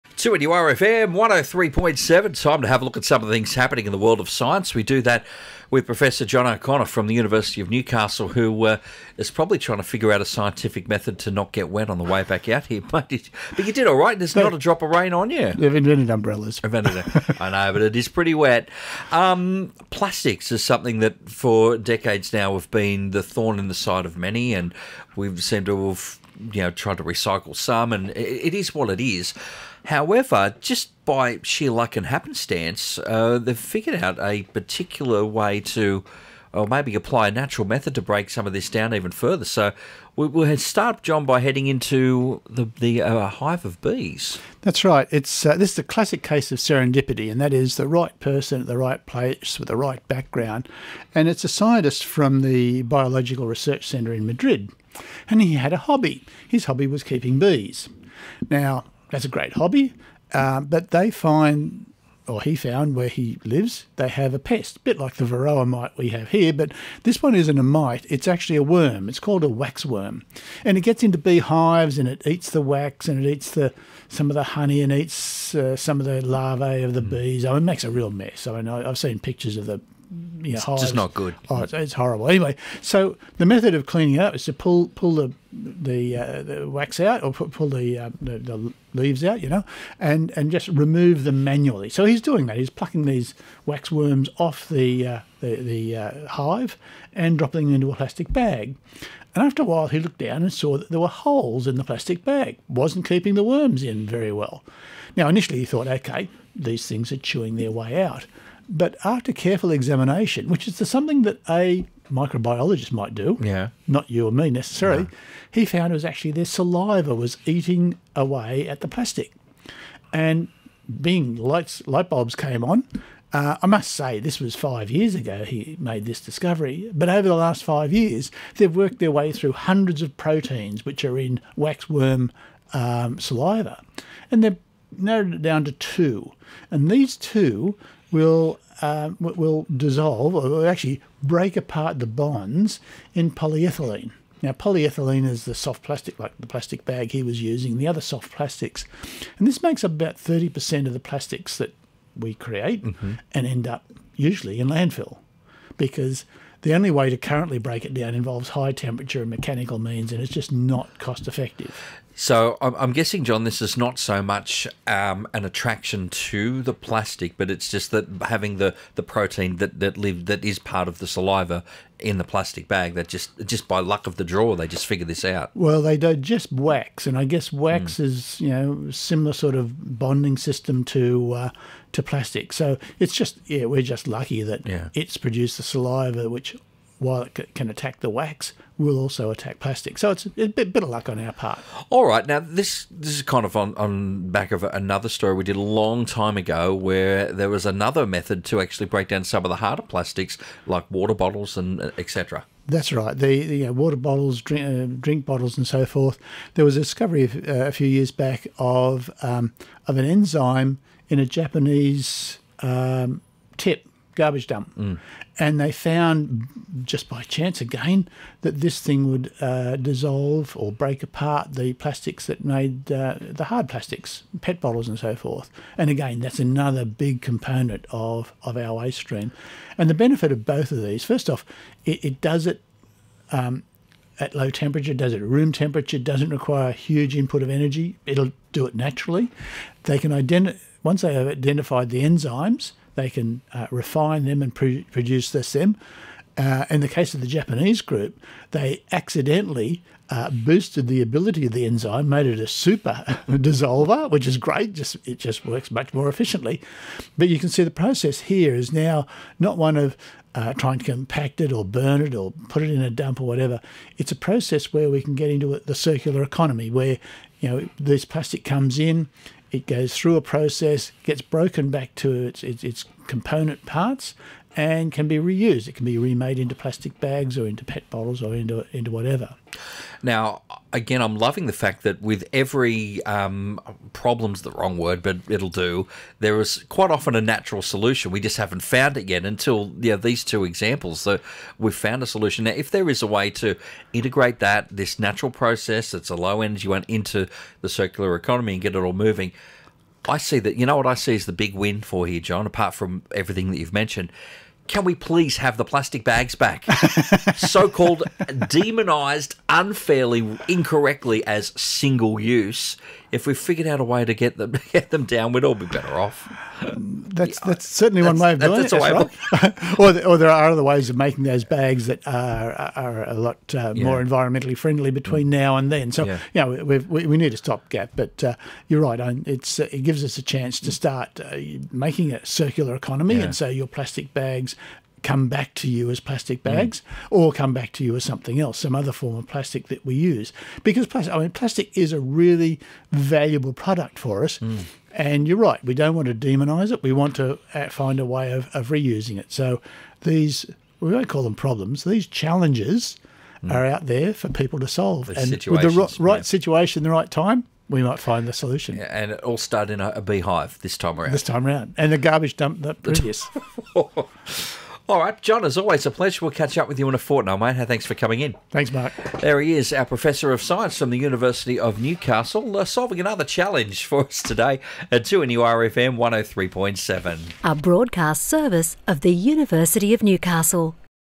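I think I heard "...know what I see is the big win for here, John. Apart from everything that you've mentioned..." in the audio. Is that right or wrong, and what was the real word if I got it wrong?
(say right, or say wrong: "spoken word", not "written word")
right.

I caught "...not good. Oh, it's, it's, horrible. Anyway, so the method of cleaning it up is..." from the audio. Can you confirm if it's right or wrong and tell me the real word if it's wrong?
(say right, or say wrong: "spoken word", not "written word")
right.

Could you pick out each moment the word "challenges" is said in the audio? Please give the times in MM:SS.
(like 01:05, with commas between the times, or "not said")
05:52, 06:13.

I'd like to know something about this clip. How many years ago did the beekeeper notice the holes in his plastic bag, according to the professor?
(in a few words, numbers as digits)
5.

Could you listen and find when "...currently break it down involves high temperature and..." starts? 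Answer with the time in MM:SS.
02:37.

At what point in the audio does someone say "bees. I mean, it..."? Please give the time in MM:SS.
01:17.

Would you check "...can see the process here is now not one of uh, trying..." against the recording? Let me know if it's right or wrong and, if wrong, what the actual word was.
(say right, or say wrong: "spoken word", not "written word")
right.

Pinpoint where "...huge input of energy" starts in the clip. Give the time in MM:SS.
03:56.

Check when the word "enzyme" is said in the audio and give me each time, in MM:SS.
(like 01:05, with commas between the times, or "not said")
03:30, 04:02, 04:11.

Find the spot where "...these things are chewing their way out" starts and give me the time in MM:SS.
01:46.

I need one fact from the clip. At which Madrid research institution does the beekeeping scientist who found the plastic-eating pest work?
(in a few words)
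Biological Research Centre.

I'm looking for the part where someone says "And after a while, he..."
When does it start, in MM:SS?
01:39.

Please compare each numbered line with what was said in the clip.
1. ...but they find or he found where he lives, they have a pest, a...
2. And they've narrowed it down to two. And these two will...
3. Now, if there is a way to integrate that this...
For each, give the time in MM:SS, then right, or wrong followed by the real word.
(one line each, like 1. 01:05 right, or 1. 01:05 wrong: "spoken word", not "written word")
1. 01:00 right
2. 02:14 right
3. 04:52 right.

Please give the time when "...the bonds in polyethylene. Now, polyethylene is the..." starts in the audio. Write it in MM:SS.
02:21.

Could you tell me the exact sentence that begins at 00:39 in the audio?
So we, will start, John, by heading into the, the uh, hive of bees.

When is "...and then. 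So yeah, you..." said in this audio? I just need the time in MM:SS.
05:25.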